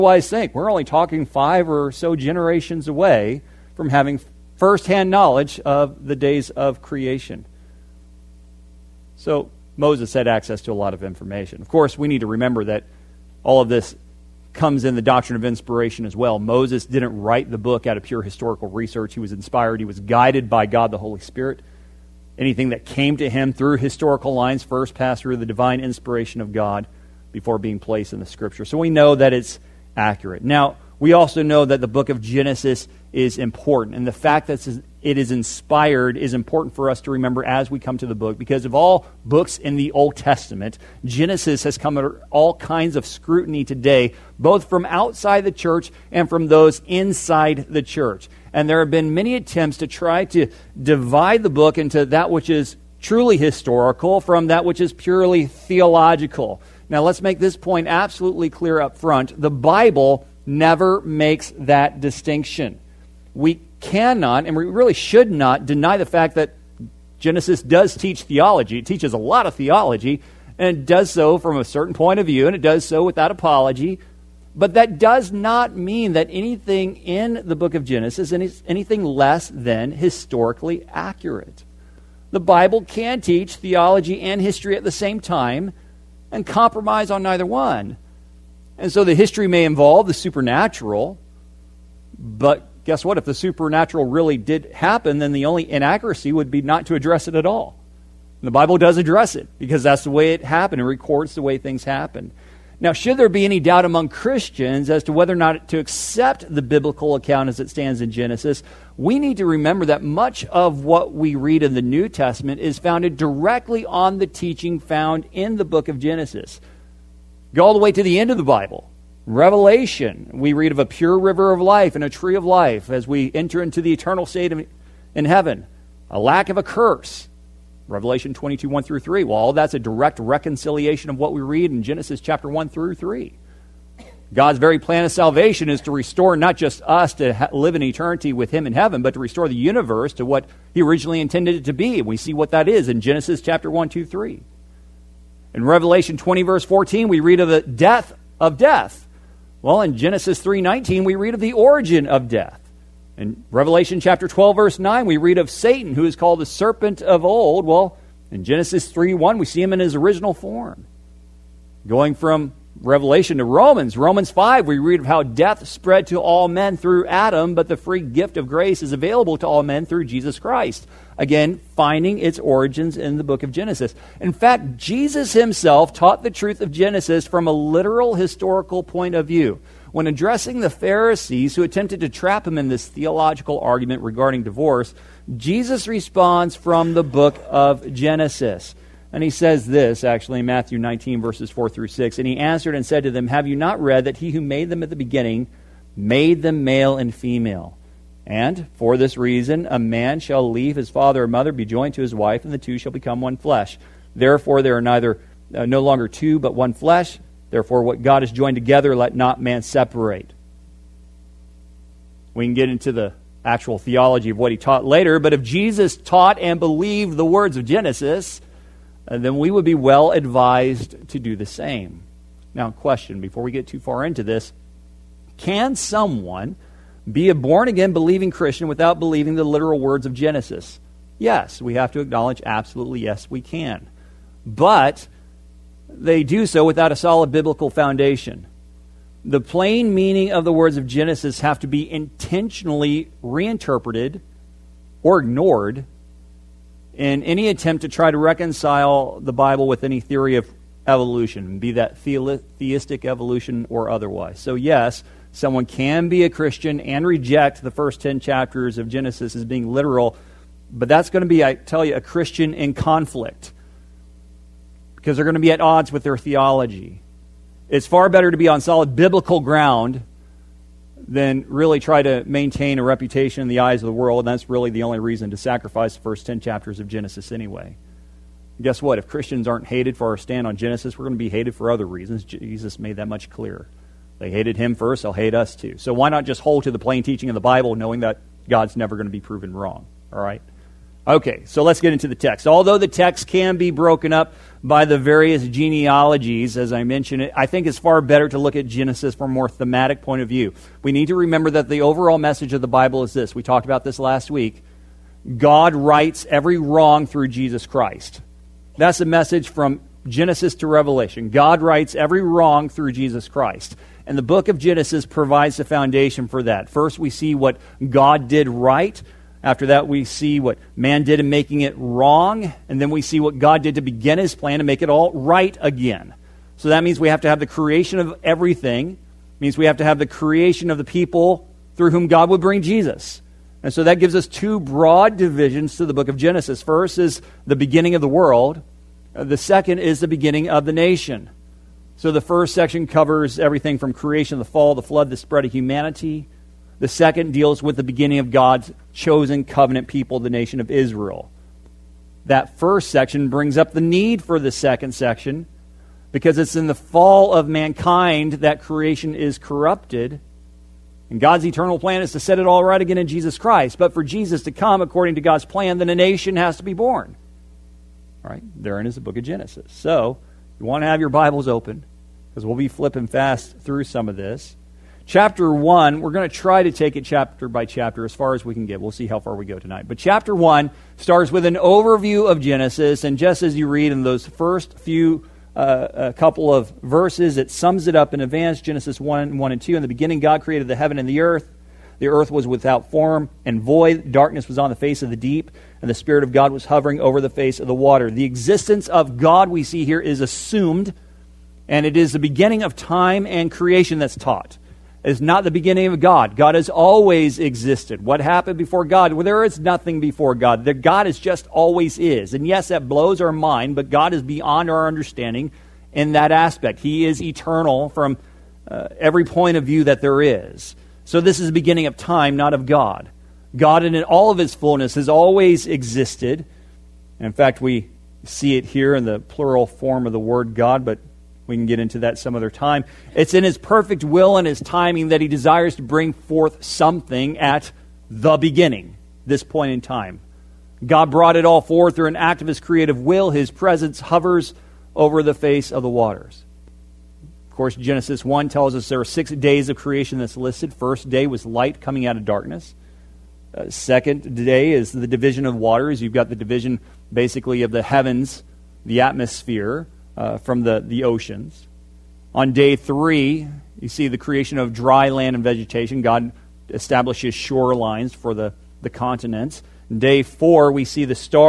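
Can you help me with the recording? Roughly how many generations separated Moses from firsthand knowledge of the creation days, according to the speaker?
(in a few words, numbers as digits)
5.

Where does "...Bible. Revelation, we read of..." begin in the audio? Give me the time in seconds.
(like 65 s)
118 s.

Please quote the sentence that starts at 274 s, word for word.
And that's really the only reason to sacrifice the first 10 chapters of Genesis anyway.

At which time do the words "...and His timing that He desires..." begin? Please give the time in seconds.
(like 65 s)
434 s.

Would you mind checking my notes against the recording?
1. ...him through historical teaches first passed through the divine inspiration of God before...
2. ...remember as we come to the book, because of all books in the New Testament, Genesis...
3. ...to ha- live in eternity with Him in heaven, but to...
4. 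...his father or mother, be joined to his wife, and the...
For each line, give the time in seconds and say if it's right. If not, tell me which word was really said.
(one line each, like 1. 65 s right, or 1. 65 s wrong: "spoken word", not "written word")
1. 23 s wrong: "lines", not "teaches"
2. 37 s wrong: "Old", not "New"
3. 137 s right
4. 200 s right.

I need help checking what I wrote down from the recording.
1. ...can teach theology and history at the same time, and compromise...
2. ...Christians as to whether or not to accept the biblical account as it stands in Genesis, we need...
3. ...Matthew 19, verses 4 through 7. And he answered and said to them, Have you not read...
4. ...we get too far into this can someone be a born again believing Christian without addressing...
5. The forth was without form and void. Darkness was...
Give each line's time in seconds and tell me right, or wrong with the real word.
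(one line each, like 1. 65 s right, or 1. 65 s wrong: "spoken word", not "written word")
1. 82 s right
2. 104 s right
3. 190 s wrong: "6", not "7"
4. 223 s wrong: "believing", not "addressing"
5. 391 s wrong: "earth", not "forth".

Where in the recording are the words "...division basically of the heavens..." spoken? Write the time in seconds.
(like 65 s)
456 s.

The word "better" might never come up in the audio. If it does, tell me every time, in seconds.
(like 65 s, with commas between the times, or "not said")
268 s, 297 s.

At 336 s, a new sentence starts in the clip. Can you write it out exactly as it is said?
First is the beginning of the world, uh, the second is the beginning of the nation.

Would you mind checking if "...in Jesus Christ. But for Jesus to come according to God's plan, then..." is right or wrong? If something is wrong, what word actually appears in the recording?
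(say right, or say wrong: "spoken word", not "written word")
right.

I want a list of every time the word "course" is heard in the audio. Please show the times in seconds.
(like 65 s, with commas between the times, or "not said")
11 s, 447 s.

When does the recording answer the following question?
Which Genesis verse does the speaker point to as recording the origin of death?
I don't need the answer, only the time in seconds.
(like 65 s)
149 s.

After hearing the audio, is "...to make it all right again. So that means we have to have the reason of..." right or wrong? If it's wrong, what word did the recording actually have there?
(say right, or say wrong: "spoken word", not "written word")
wrong: "creation", not "reason".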